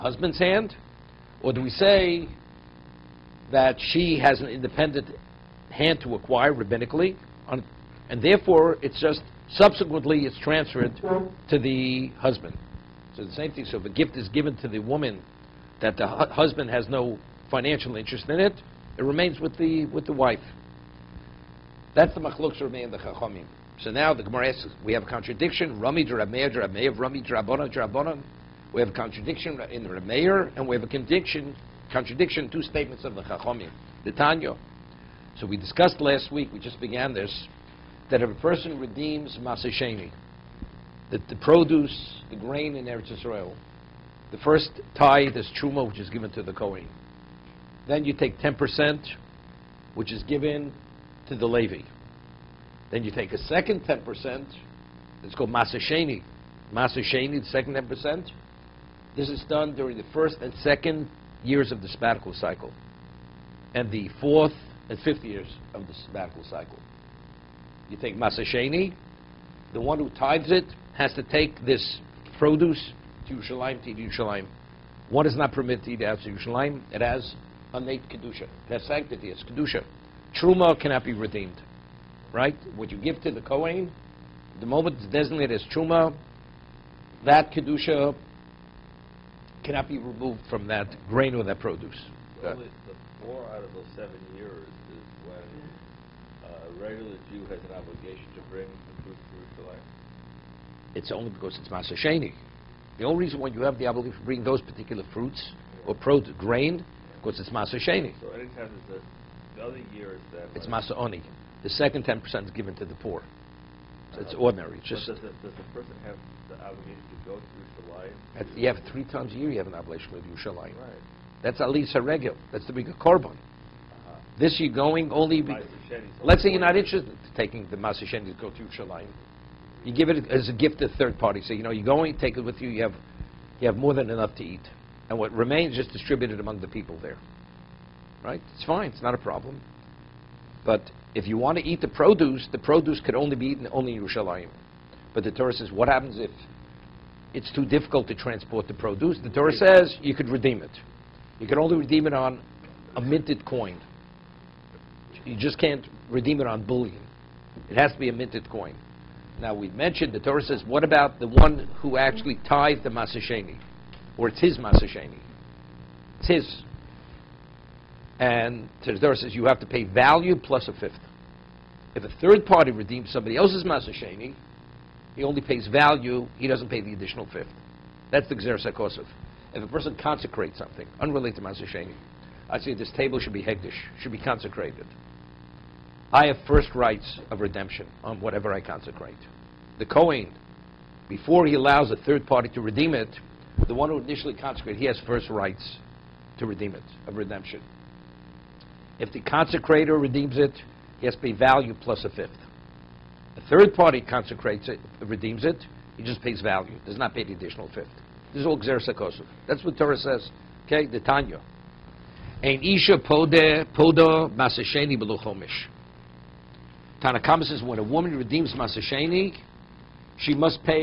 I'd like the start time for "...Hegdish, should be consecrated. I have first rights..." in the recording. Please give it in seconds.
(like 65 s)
183 s.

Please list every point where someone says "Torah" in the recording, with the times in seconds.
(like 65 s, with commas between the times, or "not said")
145 s, 149 s, 160 s, 168 s, 209 s.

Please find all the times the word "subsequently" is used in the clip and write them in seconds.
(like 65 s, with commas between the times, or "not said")
9 s.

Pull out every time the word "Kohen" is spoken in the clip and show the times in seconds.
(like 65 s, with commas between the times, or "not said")
46 s, 83 s, 189 s.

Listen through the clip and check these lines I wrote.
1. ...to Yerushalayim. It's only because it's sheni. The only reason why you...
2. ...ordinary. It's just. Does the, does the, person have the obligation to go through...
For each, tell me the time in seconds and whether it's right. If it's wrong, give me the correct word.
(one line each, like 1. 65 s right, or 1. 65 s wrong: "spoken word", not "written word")
1. 99 s right
2. 114 s right.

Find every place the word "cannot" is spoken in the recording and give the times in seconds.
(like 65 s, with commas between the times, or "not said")
80 s, 89 s.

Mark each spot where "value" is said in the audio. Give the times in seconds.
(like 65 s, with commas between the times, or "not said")
169 s, 175 s, 201 s, 206 s.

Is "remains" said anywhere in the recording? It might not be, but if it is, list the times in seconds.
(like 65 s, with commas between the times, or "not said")
19 s, 135 s.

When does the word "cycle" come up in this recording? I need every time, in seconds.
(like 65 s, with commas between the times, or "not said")
62 s, 66 s.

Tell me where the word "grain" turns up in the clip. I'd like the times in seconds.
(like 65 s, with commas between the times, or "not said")
42 s, 91 s, 106 s.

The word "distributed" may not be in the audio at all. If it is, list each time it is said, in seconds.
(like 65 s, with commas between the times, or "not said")
135 s.